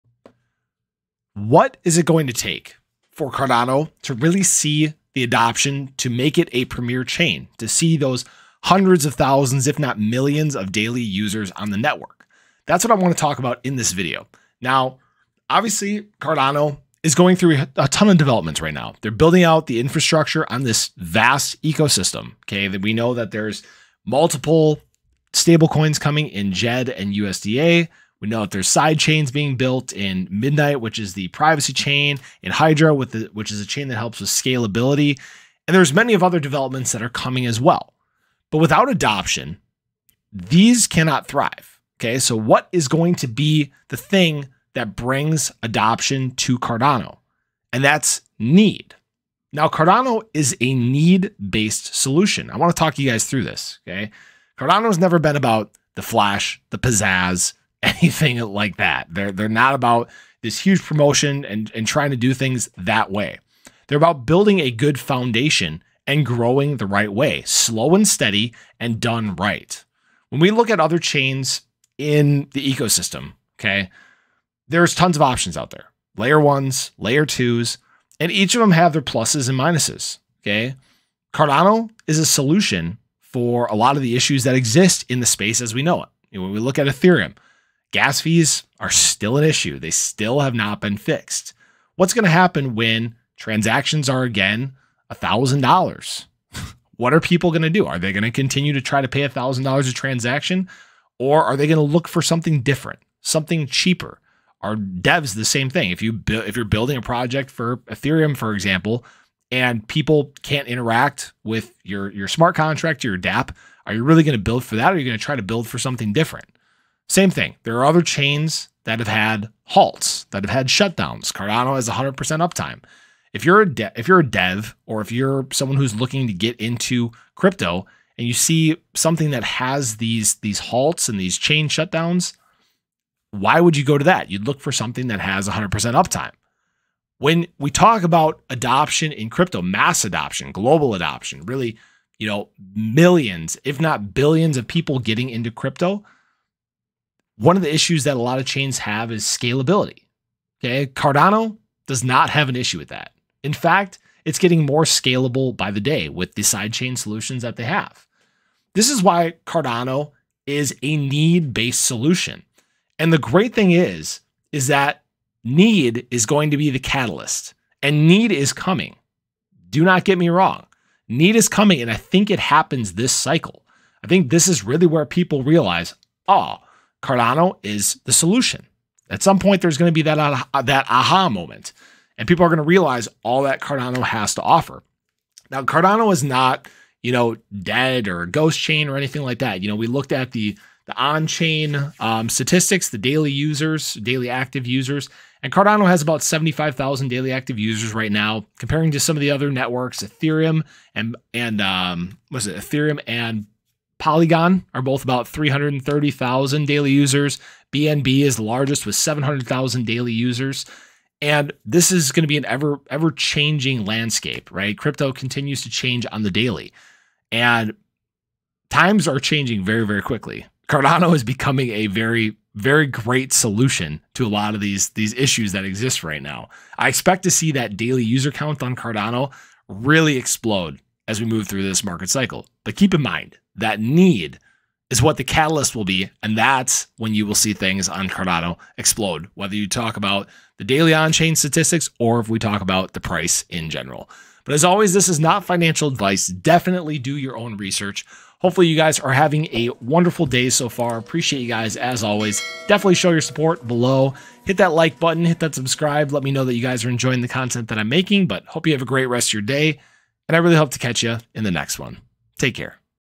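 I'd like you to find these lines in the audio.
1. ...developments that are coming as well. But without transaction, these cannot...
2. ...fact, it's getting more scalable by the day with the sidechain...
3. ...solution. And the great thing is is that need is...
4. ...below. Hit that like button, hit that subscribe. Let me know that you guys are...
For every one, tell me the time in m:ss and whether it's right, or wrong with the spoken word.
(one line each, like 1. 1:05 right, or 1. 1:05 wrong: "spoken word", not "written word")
1. 0:36 wrong: "adoption", not "transaction"
2. 2:33 right
3. 2:41 right
4. 4:13 right.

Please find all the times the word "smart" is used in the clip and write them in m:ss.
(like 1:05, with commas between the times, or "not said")
1:52.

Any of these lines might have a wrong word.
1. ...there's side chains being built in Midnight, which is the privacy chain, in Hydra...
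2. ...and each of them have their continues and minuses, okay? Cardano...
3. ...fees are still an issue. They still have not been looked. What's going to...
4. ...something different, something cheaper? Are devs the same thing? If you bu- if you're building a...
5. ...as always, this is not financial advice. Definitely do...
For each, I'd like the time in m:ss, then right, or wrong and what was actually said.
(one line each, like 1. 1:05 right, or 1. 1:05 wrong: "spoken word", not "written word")
1. 0:28 right
2. 1:18 wrong: "pluses", not "continues"
3. 1:28 wrong: "fixed", not "looked"
4. 1:42 right
5. 4:04 right.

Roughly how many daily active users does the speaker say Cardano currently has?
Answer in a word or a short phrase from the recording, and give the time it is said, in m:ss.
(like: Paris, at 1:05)
75,000, at 3:16.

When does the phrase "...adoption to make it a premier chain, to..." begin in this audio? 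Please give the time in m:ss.
0:05.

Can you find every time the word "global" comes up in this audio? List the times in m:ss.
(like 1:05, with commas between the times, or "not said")
2:20.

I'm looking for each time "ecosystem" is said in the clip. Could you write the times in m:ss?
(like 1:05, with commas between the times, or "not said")
0:21, 1:12.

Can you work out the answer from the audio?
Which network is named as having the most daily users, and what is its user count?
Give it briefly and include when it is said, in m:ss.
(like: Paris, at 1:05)
BNB, 700,000, at 3:27.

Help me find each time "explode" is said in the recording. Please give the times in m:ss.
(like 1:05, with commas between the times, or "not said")
3:50, 3:58.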